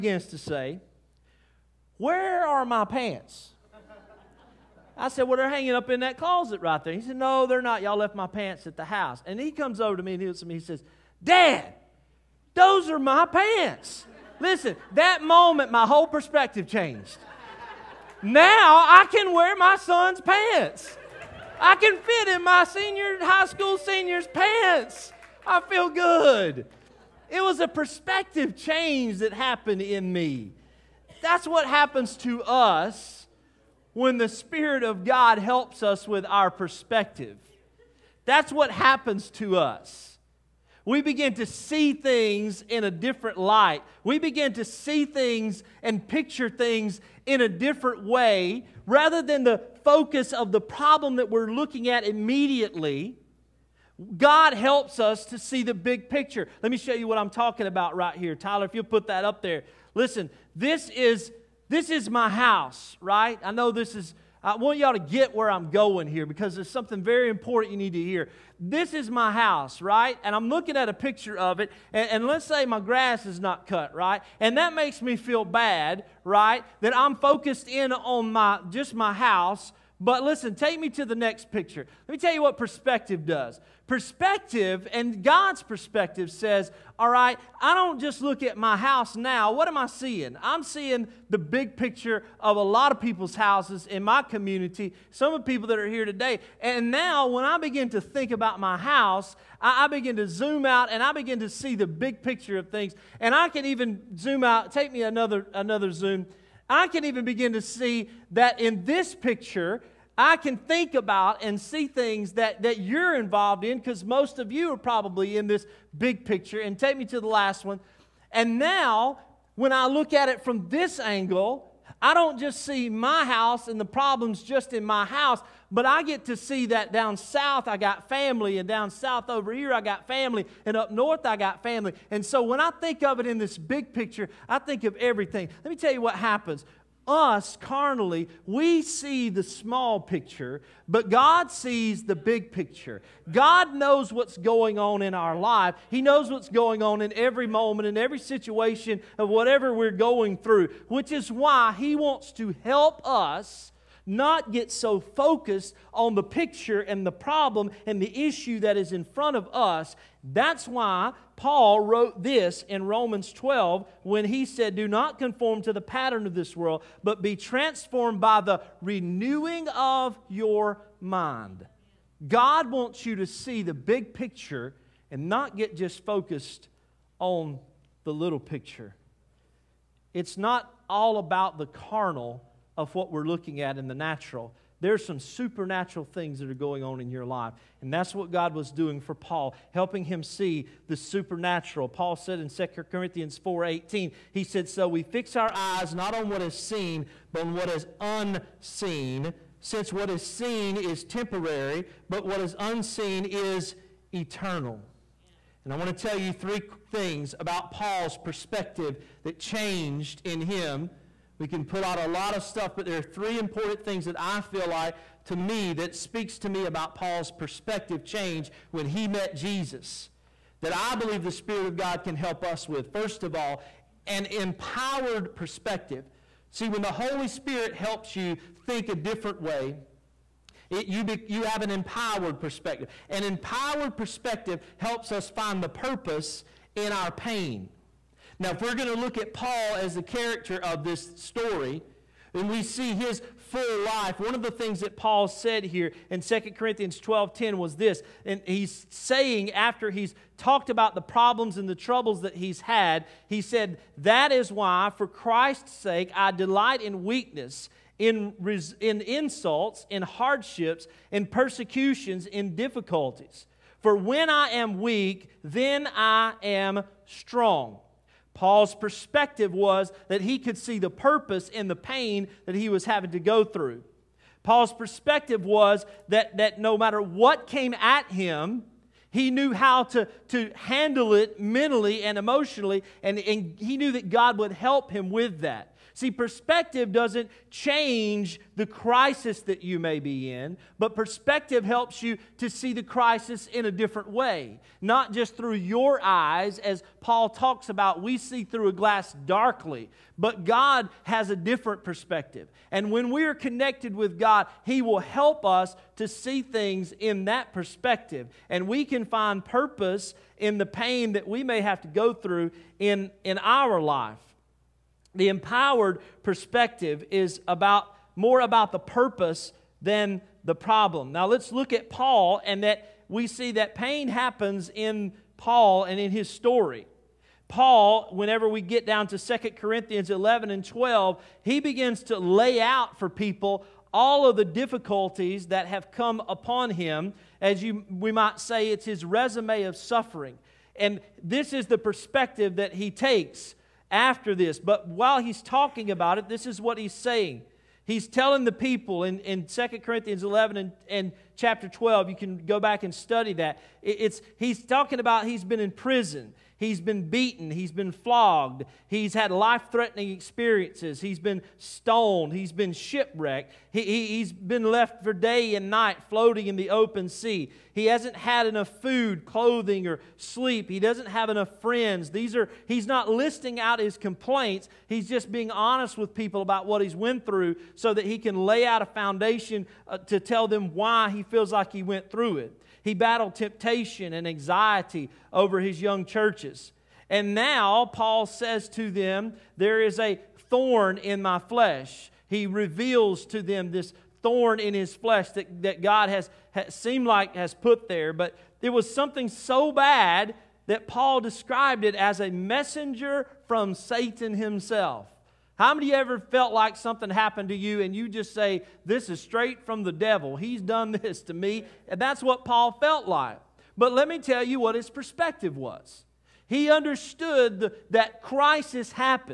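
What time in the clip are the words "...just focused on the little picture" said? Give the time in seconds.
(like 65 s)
175 s.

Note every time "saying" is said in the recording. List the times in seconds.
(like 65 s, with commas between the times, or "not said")
248 s, 346 s.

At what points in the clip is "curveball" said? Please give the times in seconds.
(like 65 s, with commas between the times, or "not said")
not said.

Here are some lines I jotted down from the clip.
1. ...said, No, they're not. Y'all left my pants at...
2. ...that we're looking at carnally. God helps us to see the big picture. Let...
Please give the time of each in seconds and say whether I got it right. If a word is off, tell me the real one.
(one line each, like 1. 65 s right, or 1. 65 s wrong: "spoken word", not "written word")
1. 7 s right
2. 51 s wrong: "immediately", not "carnally".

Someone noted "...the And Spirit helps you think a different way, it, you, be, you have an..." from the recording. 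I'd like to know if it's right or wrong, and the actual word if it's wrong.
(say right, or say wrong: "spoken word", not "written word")
wrong: "Holy", not "And".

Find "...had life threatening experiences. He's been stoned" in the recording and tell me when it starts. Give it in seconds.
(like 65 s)
359 s.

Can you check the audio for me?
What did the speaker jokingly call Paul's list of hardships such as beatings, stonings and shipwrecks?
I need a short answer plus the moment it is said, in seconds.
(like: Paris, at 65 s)
resume of suffering, at 339 s.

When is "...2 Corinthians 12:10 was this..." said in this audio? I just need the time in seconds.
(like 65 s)
246 s.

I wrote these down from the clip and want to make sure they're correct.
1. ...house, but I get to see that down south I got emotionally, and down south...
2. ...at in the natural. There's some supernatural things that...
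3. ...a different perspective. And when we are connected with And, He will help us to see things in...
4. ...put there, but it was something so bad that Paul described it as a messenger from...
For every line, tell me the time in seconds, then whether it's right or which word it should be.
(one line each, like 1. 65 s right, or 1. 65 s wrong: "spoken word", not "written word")
1. 125 s wrong: "family", not "emotionally"
2. 183 s right
3. 301 s wrong: "God", not "And"
4. 397 s right.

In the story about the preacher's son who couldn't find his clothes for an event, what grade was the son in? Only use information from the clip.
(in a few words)
high school senior.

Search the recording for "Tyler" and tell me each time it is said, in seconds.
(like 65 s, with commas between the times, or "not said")
58 s.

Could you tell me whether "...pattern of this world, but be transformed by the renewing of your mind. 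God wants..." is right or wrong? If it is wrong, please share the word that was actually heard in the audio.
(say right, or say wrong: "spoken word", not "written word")
right.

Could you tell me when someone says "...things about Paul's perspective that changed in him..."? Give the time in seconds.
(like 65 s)
206 s.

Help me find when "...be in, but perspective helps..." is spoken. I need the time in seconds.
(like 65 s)
289 s.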